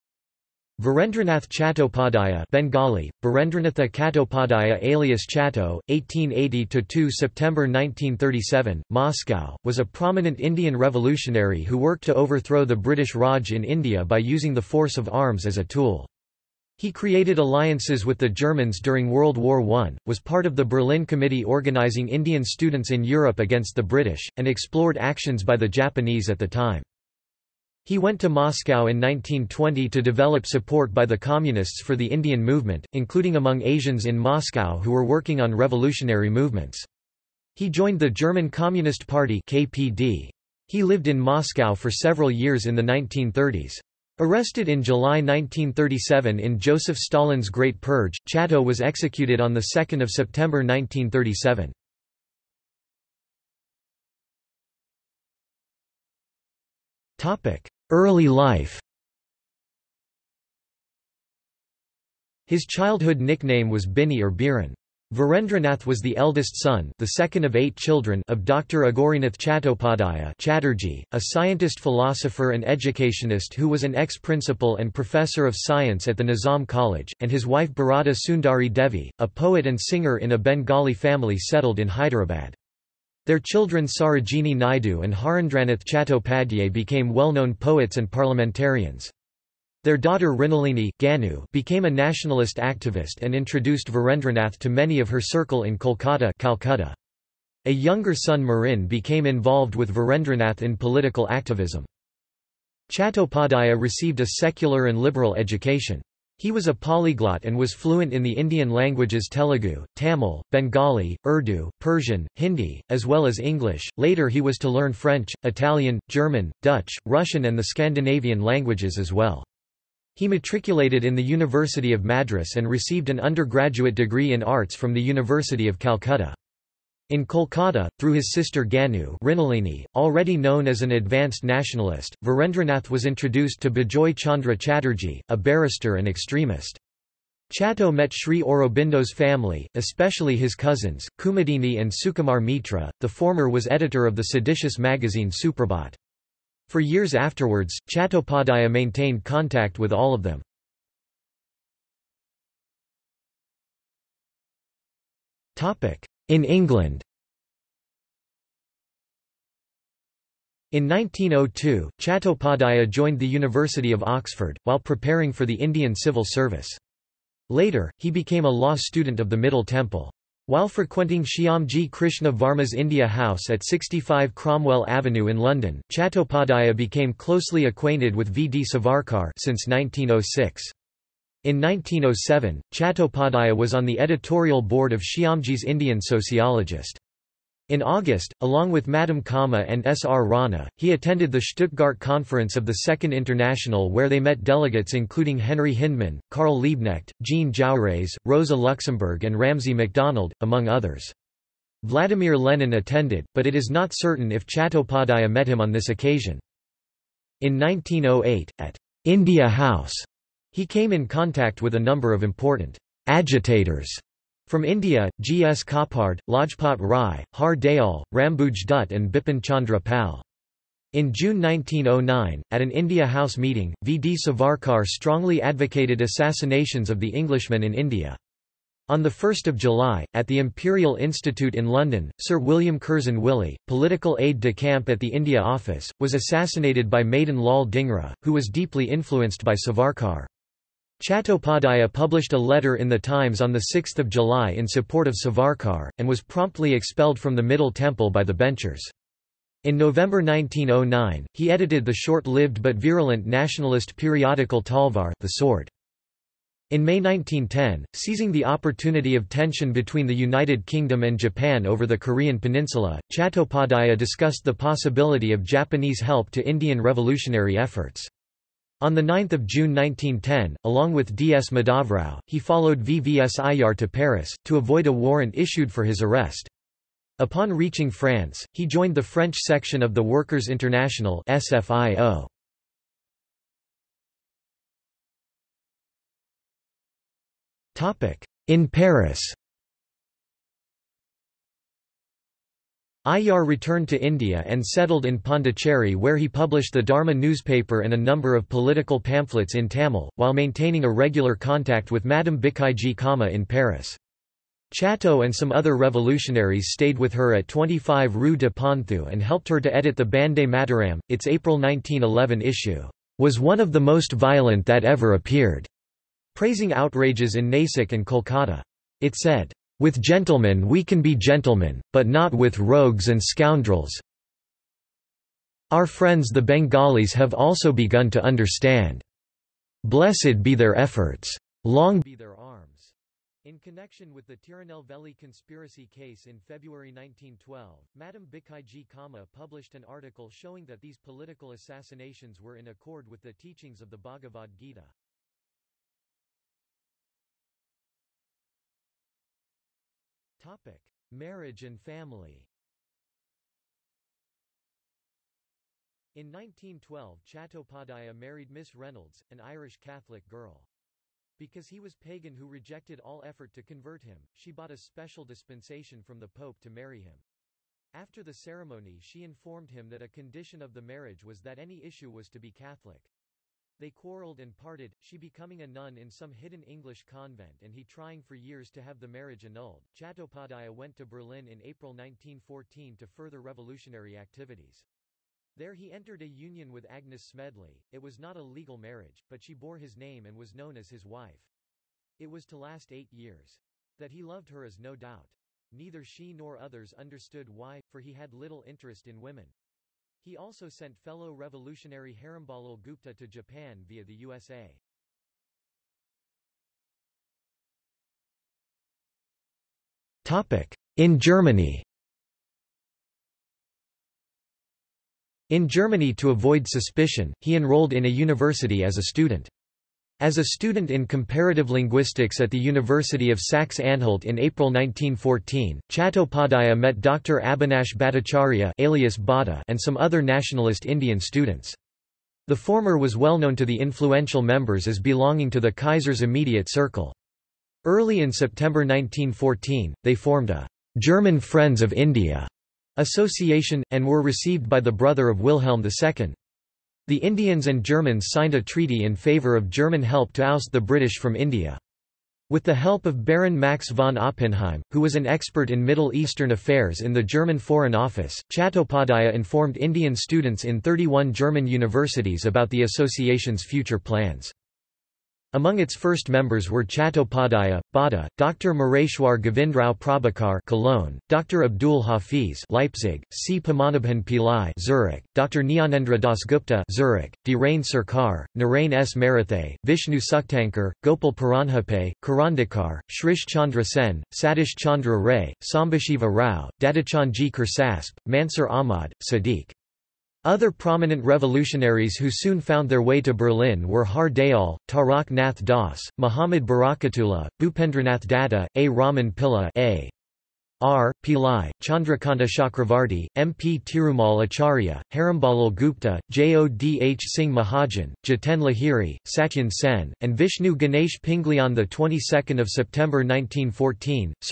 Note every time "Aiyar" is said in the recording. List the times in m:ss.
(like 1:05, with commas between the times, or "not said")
4:33, 4:53.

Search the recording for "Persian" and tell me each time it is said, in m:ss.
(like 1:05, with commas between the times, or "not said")
1:51.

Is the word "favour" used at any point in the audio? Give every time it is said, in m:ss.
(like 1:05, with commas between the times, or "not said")
7:29.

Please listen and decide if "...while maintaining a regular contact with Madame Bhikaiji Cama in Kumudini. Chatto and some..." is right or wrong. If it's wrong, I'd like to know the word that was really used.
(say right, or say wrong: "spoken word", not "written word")
wrong: "Paris", not "Kumudini".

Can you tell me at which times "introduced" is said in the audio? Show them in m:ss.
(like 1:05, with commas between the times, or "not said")
1:33, 2:13.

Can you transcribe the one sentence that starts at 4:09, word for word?
In November 1909, he edited the short-lived but virulent nationalist periodical Talvar the Sword.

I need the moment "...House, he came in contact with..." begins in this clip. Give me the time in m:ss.
3:29.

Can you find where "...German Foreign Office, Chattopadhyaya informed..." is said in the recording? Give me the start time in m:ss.
7:37.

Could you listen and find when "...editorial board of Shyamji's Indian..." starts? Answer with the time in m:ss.
3:03.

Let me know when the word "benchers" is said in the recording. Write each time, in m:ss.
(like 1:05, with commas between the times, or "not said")
4:08.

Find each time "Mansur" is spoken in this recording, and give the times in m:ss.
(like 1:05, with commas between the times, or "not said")
8:08.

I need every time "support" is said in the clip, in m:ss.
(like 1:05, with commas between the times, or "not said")
0:30, 4:04.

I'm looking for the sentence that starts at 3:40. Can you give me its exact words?
In June 1909, at an India House meeting, V.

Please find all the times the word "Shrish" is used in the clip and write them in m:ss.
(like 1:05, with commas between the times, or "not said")
8:03.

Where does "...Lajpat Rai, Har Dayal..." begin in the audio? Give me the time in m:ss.
3:36.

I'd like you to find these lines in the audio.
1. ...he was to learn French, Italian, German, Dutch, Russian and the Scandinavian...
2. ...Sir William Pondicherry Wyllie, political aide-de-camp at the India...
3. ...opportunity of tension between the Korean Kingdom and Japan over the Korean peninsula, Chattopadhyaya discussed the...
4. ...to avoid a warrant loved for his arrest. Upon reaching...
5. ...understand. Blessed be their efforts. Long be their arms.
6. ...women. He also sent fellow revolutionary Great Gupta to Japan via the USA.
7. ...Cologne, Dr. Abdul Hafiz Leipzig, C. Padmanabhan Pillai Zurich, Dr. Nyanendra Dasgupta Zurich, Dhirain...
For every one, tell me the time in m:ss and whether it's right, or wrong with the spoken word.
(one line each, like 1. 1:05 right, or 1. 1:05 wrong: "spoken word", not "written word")
1. 1:54 right
2. 3:52 wrong: "Curzon", not "Pondicherry"
3. 4:18 wrong: "United", not "Korean"
4. 4:34 wrong: "issued", not "loved"
5. 5:28 right
6. 6:39 wrong: "Herambalal", not "Great"
7. 7:50 right.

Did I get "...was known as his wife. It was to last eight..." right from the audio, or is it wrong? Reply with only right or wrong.
right.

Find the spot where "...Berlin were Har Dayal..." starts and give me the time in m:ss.
8:13.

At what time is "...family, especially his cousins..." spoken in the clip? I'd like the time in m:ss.
2:19.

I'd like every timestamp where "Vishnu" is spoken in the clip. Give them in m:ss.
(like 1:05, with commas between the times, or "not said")
7:59, 8:30.